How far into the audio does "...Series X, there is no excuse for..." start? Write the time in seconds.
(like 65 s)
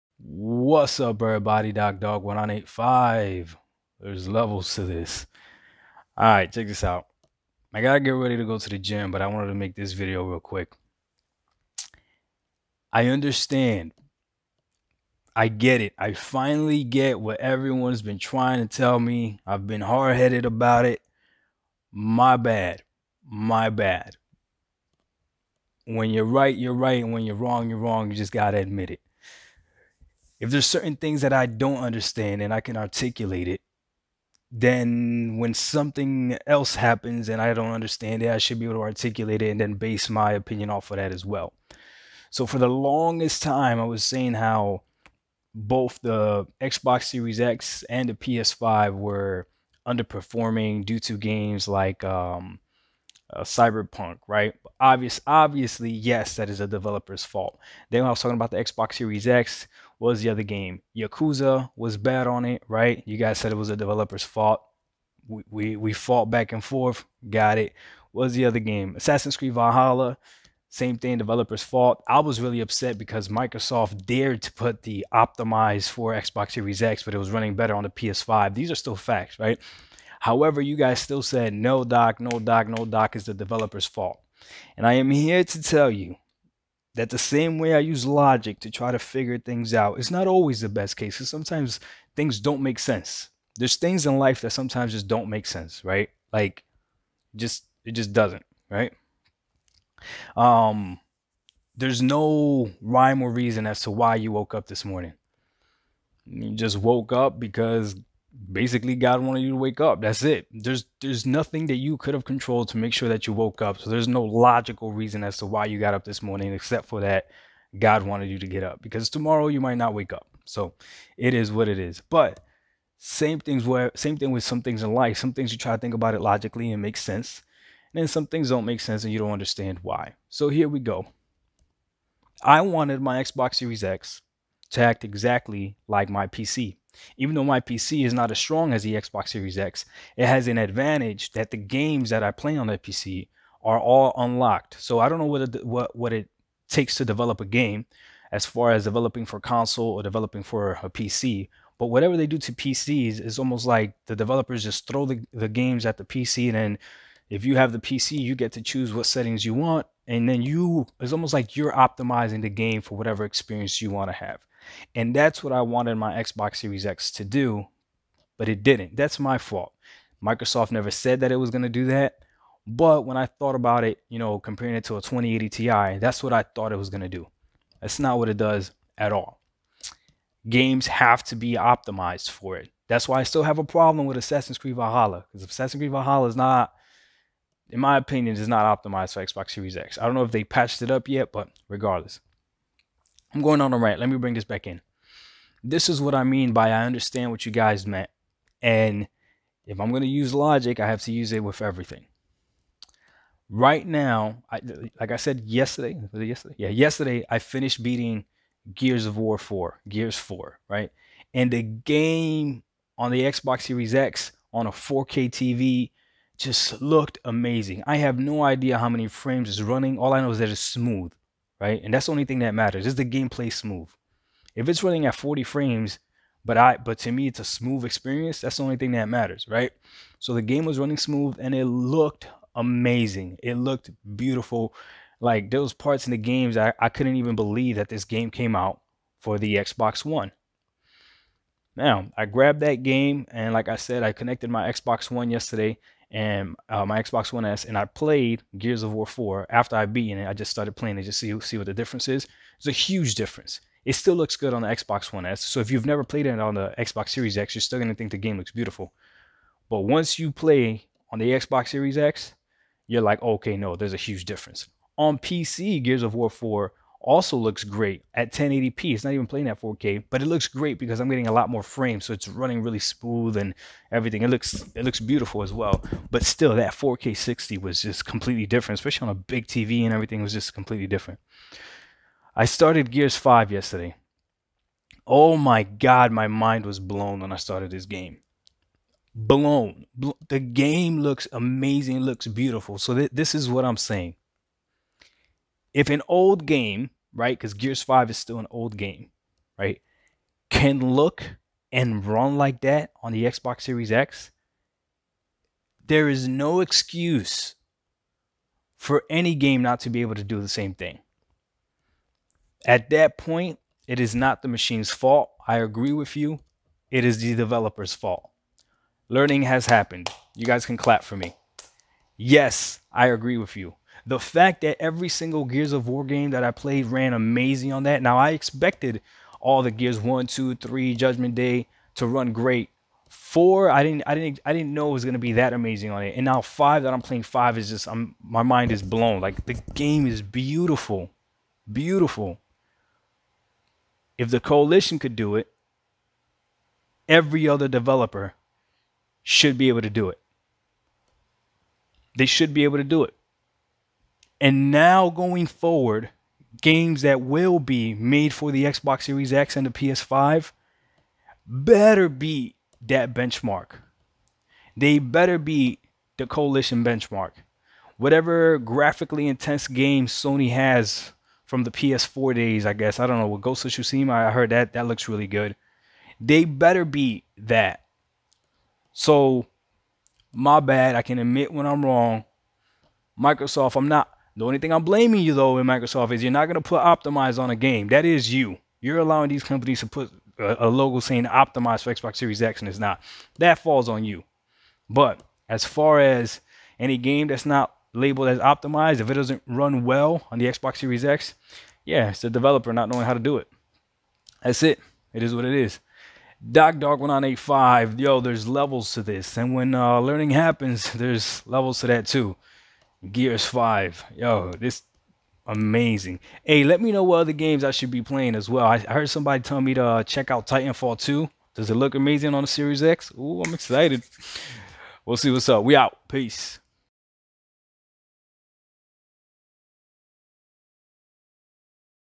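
303 s.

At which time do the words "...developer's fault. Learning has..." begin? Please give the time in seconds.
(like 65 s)
317 s.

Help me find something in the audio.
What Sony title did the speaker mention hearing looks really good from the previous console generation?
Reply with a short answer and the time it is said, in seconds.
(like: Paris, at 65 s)
Ghost of Tsushima, at 373 s.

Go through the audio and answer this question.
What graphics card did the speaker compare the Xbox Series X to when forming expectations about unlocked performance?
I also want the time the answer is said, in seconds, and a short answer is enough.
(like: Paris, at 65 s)
2080 Ti, at 175 s.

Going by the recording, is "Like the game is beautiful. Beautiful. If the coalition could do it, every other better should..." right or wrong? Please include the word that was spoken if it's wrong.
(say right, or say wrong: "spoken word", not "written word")
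wrong: "developer", not "better".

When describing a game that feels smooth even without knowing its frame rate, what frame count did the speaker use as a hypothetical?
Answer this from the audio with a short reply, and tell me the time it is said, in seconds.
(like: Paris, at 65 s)
40, at 225 s.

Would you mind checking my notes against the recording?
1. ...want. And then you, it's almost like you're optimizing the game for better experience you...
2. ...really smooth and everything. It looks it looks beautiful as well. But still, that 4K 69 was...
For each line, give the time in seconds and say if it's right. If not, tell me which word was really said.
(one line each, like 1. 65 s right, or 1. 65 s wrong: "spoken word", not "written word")
1. 159 s wrong: "whatever", not "better"
2. 272 s wrong: "60", not "69".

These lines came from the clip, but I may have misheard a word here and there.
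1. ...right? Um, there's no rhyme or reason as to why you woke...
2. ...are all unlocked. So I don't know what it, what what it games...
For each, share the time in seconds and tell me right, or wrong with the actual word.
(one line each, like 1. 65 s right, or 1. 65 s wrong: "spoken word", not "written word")
1. 98 s right
2. 143 s wrong: "takes", not "games".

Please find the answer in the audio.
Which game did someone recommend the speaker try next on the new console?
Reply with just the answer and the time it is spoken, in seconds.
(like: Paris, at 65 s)
Titanfall 2, at 420 s.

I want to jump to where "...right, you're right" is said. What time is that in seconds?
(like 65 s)
26 s.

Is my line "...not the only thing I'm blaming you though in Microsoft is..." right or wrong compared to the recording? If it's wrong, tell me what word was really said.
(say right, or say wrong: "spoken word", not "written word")
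right.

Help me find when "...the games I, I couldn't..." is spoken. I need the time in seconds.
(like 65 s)
236 s.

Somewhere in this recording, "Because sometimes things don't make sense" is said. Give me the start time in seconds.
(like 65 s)
91 s.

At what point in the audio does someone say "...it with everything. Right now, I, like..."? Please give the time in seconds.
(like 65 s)
201 s.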